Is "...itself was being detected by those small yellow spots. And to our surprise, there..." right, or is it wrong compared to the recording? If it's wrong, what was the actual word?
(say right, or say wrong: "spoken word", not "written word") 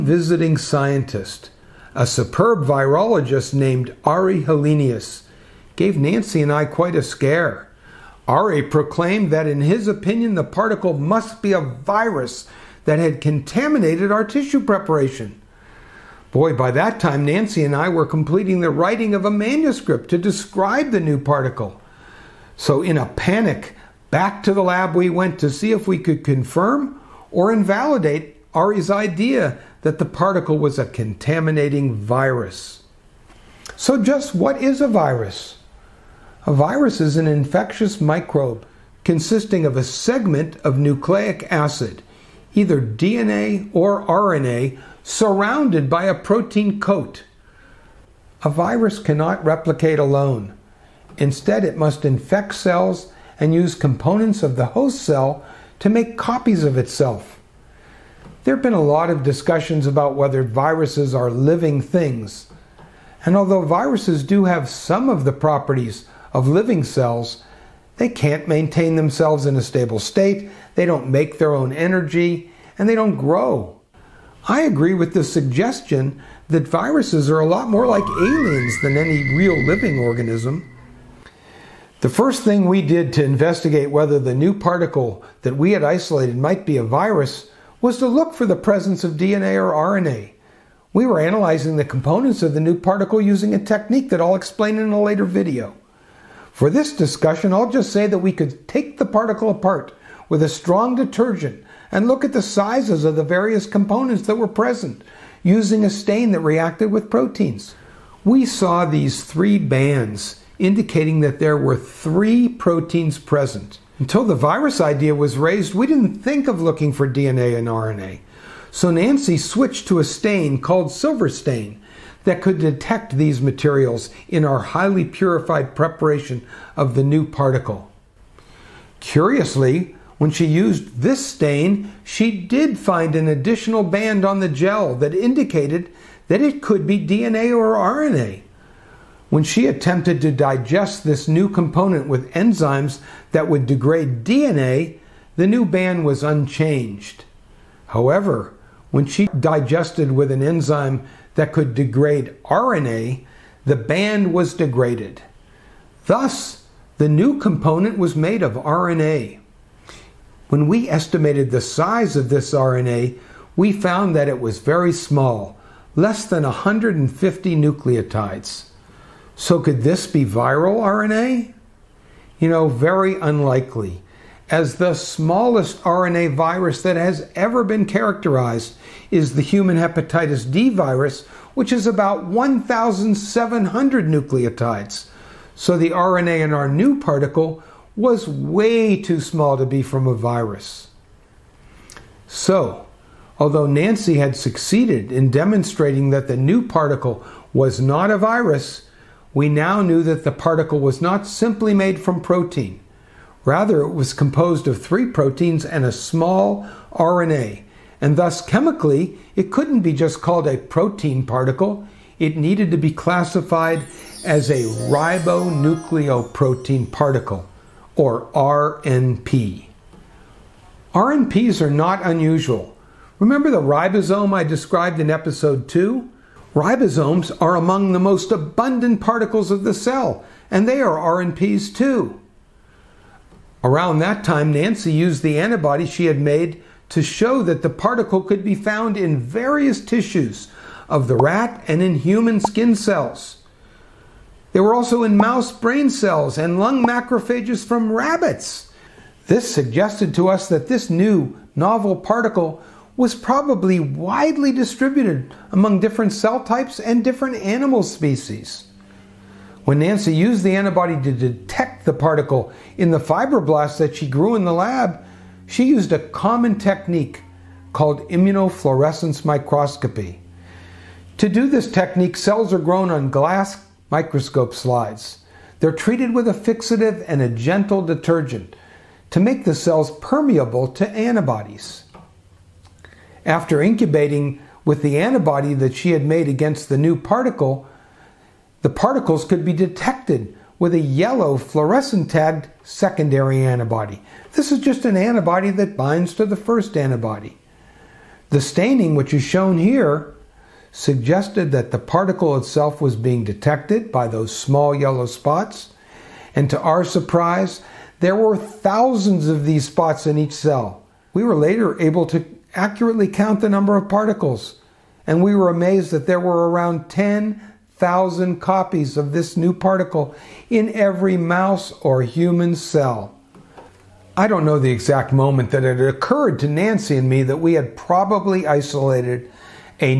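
right.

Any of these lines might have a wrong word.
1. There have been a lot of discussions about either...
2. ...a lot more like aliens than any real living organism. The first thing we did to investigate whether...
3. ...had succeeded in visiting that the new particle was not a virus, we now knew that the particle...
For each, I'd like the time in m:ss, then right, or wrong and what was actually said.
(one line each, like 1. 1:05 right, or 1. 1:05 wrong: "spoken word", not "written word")
1. 0:58 wrong: "whether", not "either"
2. 1:17 right
3. 3:14 wrong: "demonstrating", not "visiting".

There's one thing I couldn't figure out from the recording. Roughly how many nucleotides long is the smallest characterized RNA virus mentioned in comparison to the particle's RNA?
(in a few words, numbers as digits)
1,700.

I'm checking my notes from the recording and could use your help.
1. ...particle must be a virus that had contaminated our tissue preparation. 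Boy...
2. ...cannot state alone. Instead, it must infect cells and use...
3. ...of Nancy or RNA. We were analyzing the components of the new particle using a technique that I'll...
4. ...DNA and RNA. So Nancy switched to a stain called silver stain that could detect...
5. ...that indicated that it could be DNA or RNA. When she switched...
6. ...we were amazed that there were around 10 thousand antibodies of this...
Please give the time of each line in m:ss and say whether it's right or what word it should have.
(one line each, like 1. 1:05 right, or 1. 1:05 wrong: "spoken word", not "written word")
1. 0:10 right
2. 0:48 wrong: "replicate", not "state"
3. 1:29 wrong: "DNA", not "Nancy"
4. 1:57 right
5. 2:14 wrong: "attempted", not "switched"
6. 5:15 wrong: "copies", not "antibodies".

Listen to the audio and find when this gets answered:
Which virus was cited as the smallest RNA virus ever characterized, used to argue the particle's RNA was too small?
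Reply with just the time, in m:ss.
2:59.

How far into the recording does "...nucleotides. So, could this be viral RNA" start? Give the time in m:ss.
2:47.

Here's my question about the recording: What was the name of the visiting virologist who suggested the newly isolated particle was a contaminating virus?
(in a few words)
Ari Helenius.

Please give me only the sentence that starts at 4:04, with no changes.
They were also in mouse brain cells and lung macrophages from rabbits.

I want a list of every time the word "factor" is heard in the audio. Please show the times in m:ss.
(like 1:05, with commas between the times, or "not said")
not said.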